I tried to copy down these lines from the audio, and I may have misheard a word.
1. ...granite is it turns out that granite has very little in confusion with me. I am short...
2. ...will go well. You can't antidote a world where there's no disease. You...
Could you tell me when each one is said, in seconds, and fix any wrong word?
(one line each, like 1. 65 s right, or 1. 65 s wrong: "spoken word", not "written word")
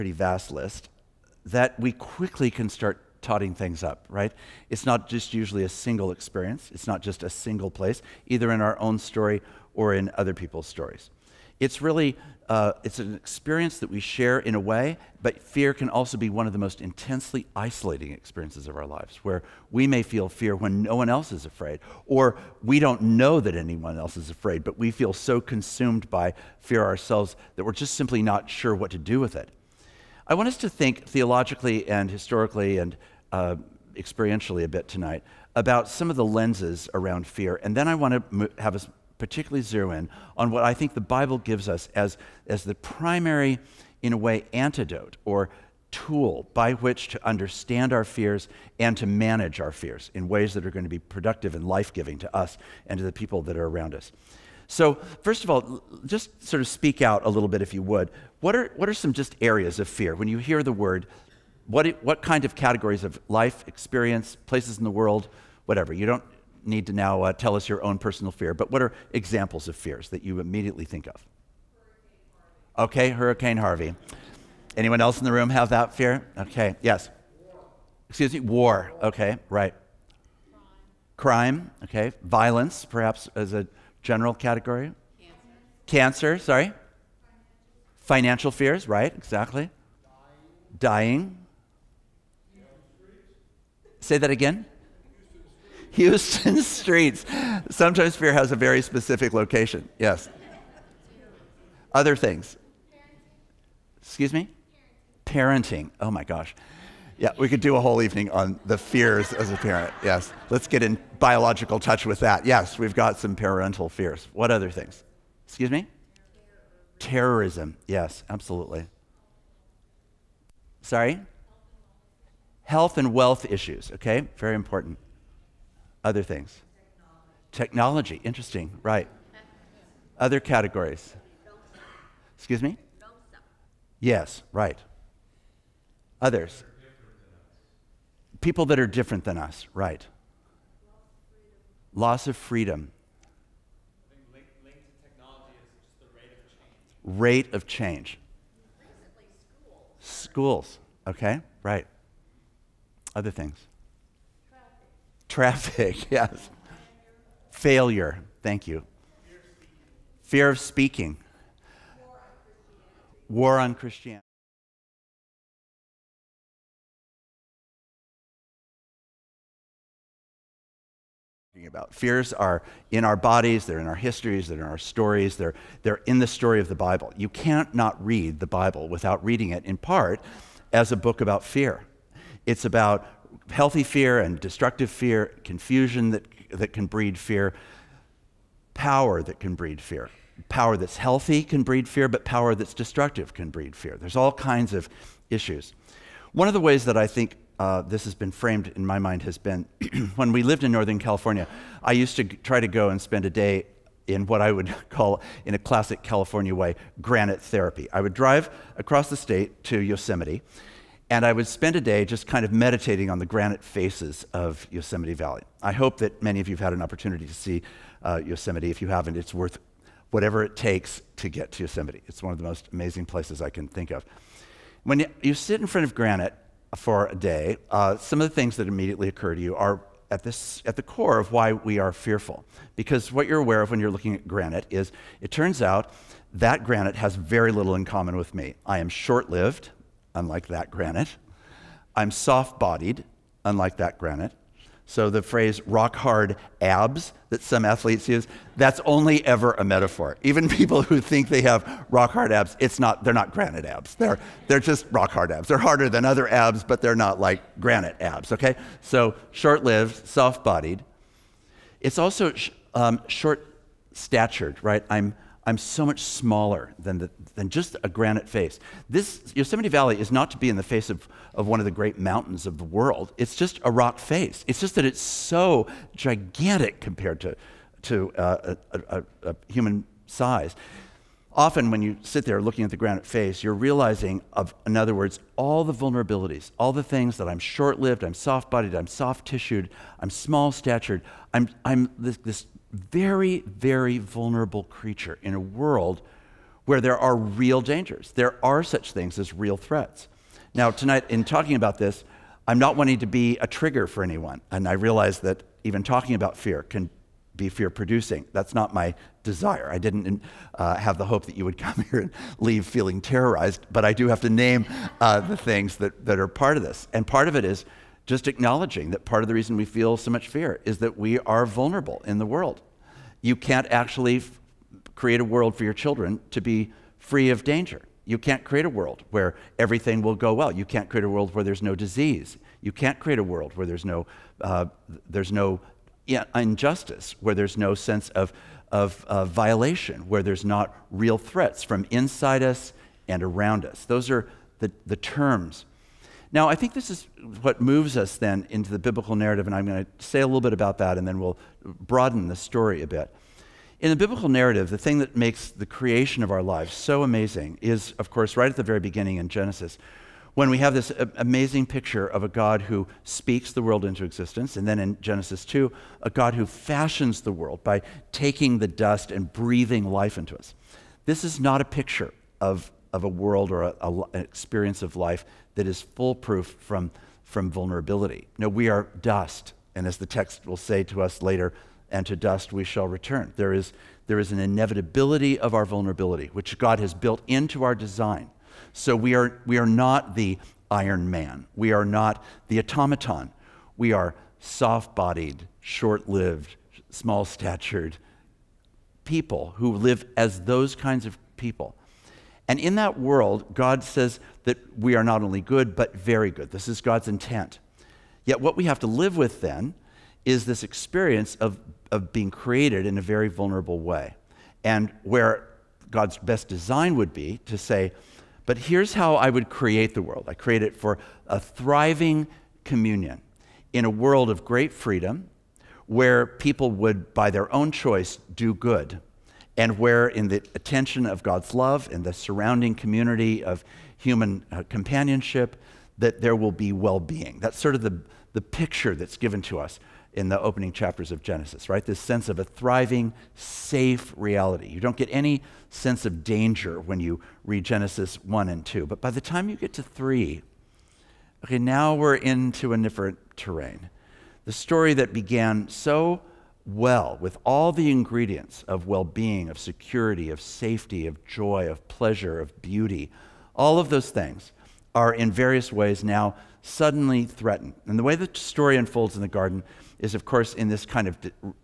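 1. 234 s wrong: "common", not "confusion"
2. 330 s wrong: "create", not "antidote".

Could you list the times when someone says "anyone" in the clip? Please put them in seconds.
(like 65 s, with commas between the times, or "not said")
23 s, 74 s, 304 s.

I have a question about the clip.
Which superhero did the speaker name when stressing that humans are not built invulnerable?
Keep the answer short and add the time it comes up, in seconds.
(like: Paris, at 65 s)
Iron Man, at 390 s.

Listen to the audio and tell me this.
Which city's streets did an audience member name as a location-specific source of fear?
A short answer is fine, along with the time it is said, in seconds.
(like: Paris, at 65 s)
Houston, at 95 s.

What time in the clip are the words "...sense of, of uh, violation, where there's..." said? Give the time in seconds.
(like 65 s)
337 s.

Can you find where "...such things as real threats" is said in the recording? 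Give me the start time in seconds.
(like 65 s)
298 s.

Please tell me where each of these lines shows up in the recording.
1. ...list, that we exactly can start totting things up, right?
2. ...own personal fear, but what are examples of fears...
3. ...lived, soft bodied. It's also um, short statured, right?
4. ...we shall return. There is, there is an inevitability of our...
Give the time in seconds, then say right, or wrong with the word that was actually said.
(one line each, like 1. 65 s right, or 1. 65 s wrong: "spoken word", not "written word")
1. 0 s wrong: "quickly", not "exactly"
2. 67 s right
3. 259 s right
4. 382 s right.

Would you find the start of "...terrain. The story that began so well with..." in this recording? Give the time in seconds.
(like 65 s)
453 s.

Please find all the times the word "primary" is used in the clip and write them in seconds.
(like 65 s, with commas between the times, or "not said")
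42 s.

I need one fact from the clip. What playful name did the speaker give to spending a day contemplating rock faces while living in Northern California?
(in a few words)
granite therapy.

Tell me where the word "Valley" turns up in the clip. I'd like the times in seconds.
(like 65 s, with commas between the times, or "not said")
215 s, 269 s.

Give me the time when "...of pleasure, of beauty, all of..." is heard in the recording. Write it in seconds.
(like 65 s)
461 s.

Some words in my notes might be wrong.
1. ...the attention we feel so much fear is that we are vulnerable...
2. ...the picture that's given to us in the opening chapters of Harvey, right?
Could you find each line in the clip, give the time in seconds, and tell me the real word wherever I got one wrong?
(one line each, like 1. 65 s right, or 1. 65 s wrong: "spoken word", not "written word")
1. 319 s wrong: "reason", not "attention"
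2. 438 s wrong: "Genesis", not "Harvey".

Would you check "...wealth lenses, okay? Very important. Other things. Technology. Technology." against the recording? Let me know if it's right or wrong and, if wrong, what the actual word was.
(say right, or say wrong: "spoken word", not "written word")
wrong: "issues", not "lenses".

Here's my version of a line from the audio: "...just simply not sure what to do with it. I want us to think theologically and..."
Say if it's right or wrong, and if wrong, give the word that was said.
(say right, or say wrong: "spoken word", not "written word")
right.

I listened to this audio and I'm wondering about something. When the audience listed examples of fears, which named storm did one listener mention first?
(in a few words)
Hurricane Harvey.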